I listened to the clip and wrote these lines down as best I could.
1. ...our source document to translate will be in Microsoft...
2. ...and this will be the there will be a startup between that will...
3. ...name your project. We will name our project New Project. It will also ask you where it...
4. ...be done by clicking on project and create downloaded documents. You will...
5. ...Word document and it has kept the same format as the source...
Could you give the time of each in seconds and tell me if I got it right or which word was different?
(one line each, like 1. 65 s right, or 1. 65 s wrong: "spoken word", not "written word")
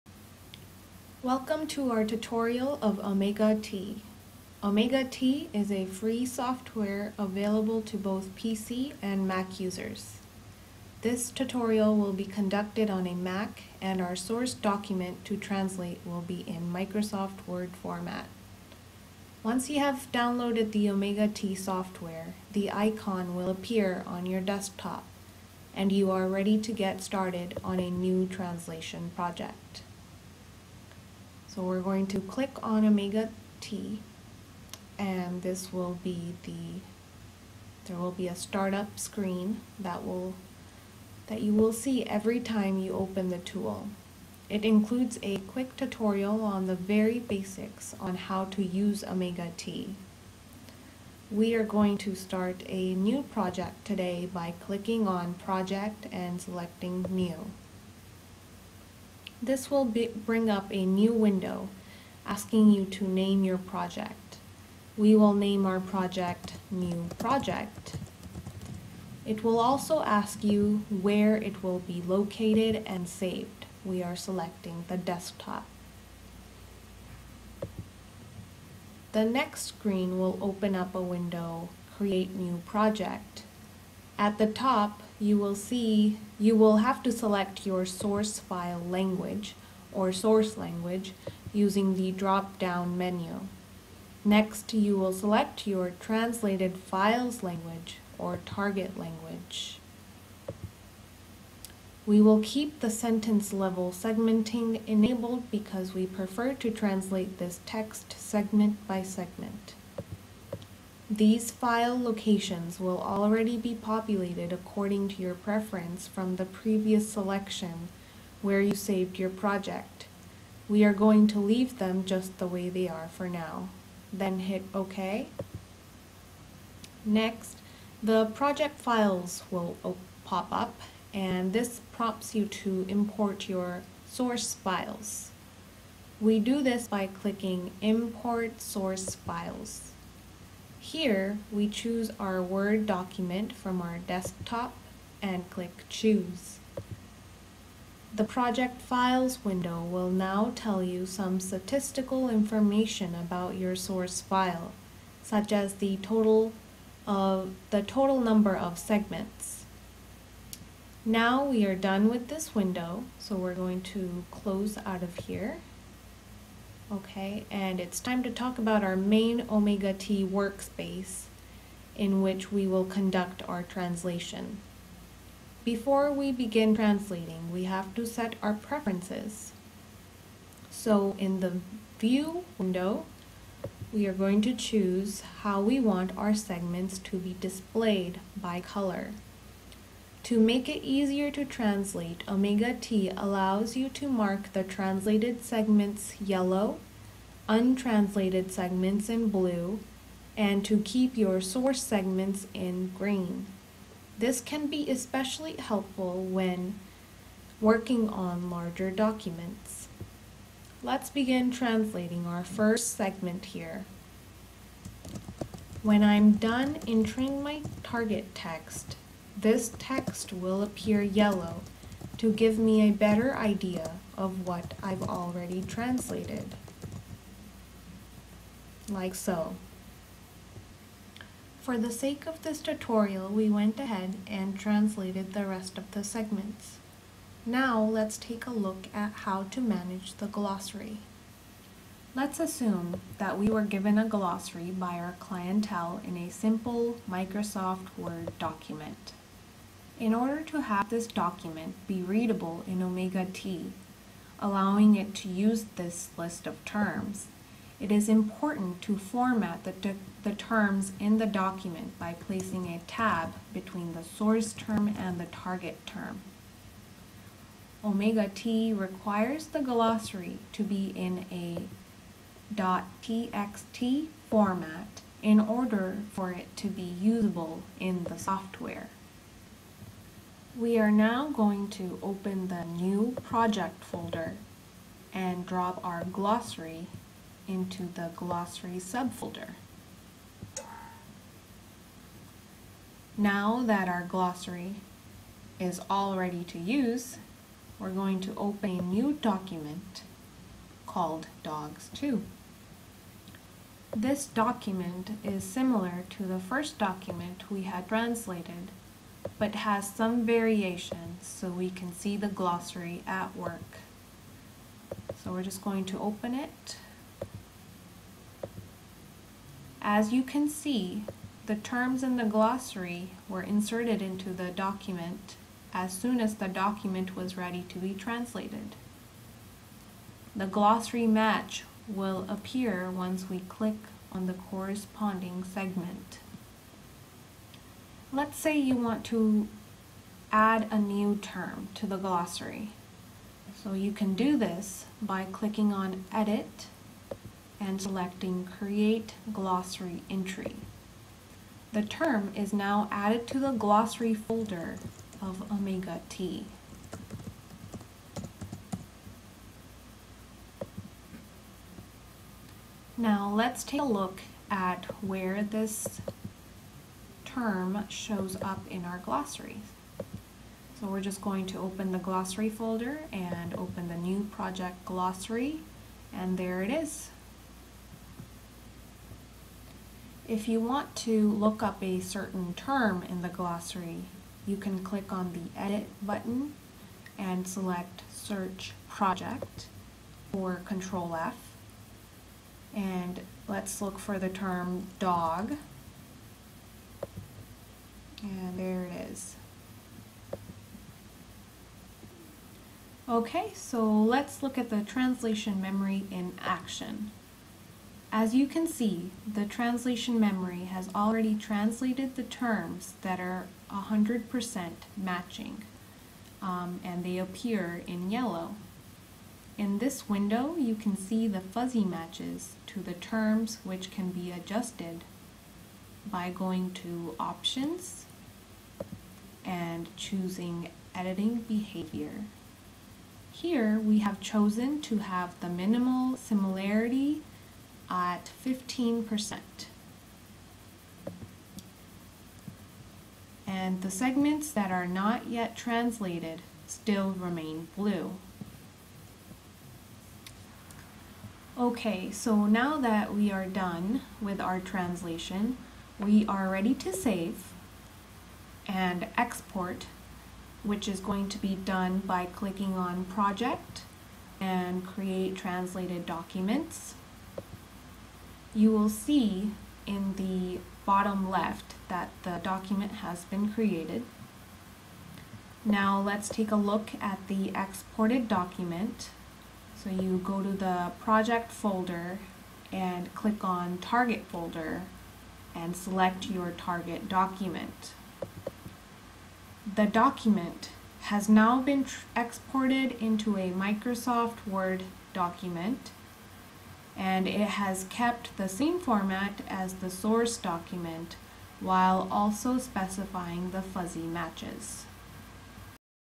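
1. 14 s right
2. 34 s wrong: "screen", not "between"
3. 63 s right
4. 461 s wrong: "translated", not "downloaded"
5. 494 s right.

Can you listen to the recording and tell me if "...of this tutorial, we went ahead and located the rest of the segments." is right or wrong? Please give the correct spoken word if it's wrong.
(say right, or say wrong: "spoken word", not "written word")
wrong: "translated", not "located".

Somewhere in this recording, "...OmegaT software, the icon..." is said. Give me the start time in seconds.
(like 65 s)
20 s.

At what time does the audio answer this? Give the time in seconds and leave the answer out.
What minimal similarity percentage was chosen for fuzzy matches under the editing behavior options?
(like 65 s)
438 s.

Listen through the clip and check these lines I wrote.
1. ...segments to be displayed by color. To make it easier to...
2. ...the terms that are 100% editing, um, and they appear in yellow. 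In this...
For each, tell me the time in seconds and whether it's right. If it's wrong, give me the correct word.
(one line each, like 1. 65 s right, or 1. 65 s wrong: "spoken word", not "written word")
1. 186 s right
2. 412 s wrong: "matching", not "editing".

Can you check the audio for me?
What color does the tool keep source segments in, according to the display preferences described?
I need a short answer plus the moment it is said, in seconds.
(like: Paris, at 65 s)
Green, at 202 s.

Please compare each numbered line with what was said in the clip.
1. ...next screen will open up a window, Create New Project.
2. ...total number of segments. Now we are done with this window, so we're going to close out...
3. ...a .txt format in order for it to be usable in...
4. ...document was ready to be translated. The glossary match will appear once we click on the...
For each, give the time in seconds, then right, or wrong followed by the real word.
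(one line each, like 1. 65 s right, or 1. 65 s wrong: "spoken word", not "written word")
1. 79 s right
2. 157 s right
3. 271 s right
4. 326 s right.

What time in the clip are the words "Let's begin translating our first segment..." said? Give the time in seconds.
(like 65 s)
210 s.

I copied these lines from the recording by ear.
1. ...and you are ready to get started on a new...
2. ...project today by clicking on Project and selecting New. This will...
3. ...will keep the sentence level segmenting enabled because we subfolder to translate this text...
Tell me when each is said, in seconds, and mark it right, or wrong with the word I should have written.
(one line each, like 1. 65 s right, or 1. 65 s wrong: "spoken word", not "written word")
1. 25 s right
2. 53 s right
3. 102 s wrong: "prefer", not "subfolder".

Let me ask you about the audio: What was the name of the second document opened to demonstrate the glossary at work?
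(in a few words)
Dogs2.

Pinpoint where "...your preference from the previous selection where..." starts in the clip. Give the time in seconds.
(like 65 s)
115 s.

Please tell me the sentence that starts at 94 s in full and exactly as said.
Next, you will select your translated files language or target language.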